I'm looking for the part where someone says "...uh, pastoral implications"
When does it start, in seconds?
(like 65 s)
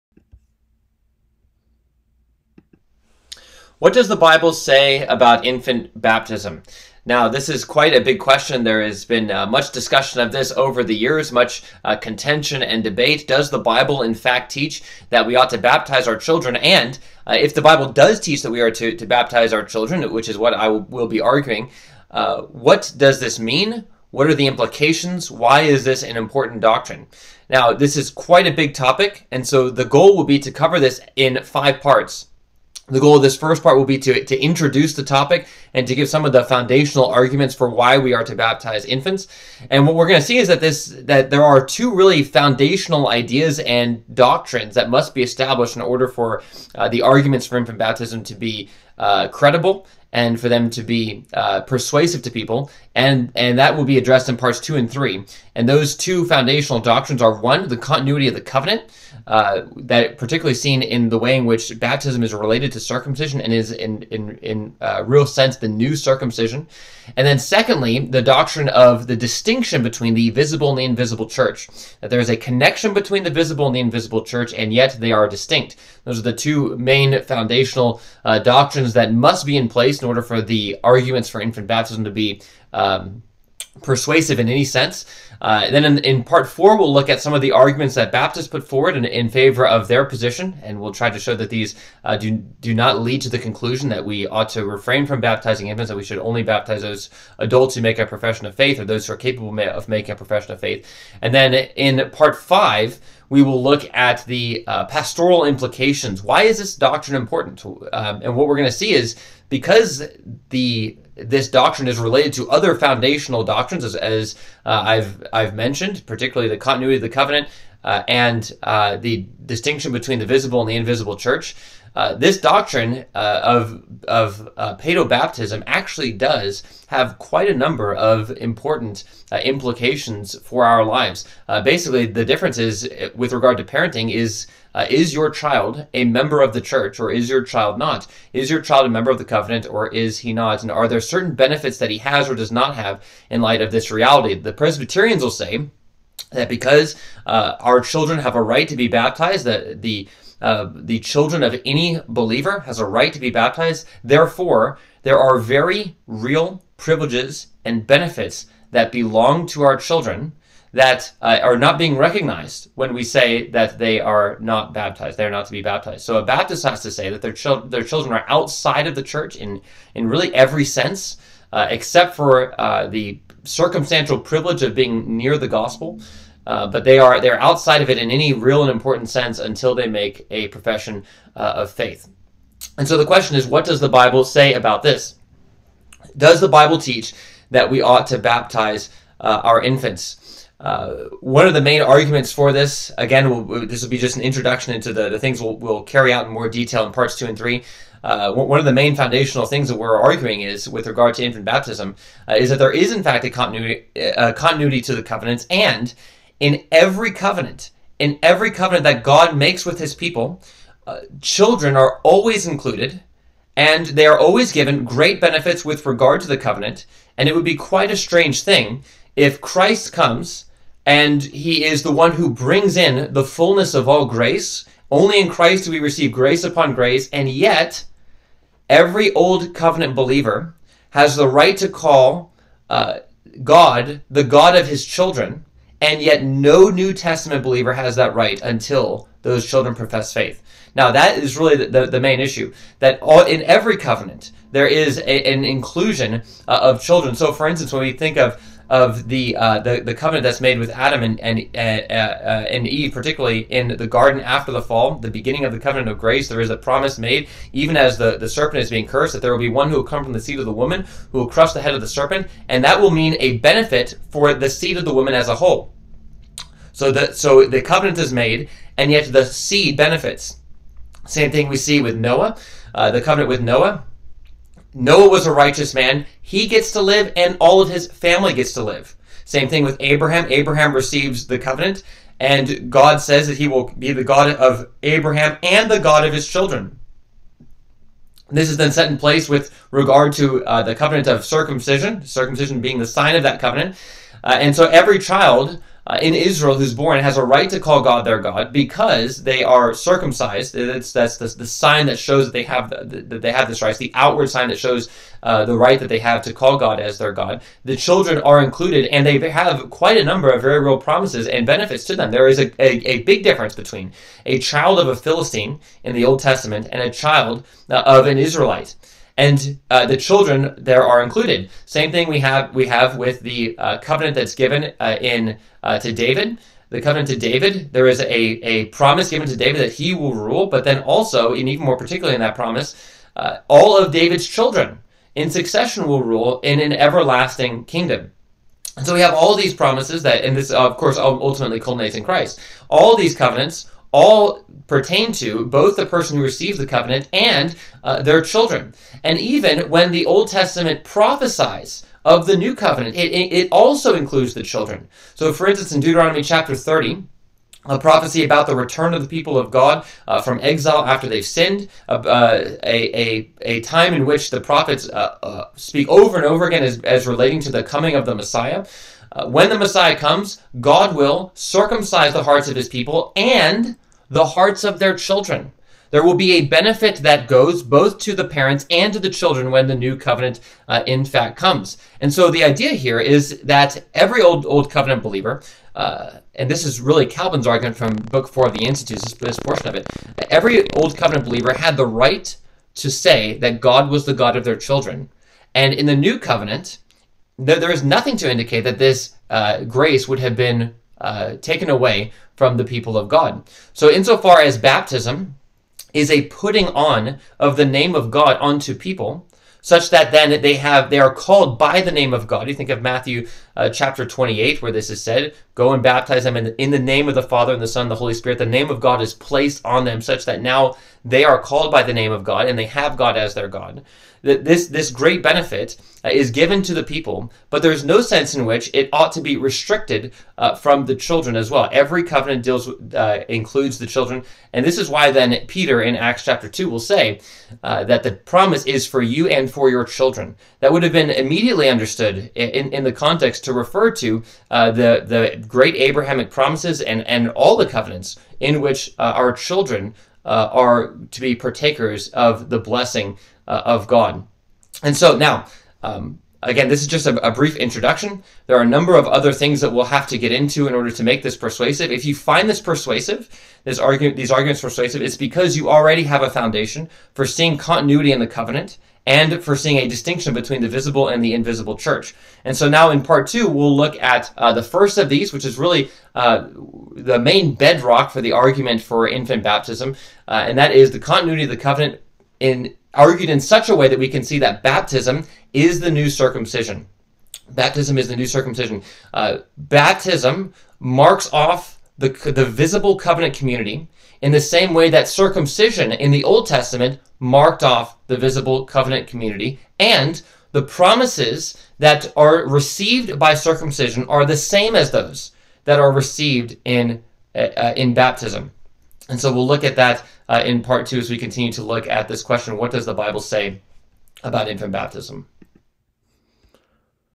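104 s.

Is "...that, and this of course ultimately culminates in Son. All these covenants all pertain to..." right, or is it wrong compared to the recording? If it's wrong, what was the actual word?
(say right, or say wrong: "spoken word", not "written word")
wrong: "Christ", not "Son".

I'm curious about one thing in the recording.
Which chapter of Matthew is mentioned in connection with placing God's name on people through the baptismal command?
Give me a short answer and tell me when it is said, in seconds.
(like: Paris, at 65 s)
Chapter 28, at 413 s.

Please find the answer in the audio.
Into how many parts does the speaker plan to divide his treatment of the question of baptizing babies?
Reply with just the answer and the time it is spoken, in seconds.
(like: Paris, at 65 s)
5, at 31 s.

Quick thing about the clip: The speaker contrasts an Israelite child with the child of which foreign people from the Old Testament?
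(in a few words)
Philistine.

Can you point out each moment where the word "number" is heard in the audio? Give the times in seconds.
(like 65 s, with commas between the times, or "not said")
127 s, 310 s, 458 s.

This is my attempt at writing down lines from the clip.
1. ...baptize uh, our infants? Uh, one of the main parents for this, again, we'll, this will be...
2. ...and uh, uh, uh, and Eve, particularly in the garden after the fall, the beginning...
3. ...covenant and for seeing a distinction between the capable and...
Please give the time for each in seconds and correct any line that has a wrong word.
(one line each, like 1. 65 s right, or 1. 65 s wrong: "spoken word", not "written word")
1. 188 s wrong: "arguments", not "parents"
2. 251 s right
3. 468 s wrong: "visible", not "capable".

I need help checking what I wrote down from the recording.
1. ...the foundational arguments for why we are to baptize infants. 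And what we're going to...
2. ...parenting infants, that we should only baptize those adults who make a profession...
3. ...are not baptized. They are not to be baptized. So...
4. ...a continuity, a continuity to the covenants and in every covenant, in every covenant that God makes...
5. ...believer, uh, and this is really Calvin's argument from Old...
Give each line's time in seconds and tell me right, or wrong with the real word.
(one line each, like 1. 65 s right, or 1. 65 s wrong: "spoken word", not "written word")
1. 36 s right
2. 95 s wrong: "baptizing", not "parenting"
3. 163 s right
4. 203 s right
5. 385 s wrong: "Book", not "Old".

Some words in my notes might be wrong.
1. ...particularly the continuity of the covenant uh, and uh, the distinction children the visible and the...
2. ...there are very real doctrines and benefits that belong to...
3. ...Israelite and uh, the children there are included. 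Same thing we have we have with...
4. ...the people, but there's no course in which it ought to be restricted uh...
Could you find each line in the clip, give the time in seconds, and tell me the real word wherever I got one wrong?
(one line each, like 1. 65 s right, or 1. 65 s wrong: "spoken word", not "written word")
1. 116 s wrong: "between", not "children"
2. 155 s wrong: "privileges", not "doctrines"
3. 318 s right
4. 426 s wrong: "sense", not "course".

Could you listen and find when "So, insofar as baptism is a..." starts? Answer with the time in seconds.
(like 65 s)
403 s.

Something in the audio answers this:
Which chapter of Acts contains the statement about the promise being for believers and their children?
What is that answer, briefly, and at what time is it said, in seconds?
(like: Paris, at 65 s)
Chapter 2, at 435 s.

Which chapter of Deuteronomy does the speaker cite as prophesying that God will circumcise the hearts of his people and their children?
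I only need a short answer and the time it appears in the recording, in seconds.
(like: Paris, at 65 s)
Chapter 30, at 356 s.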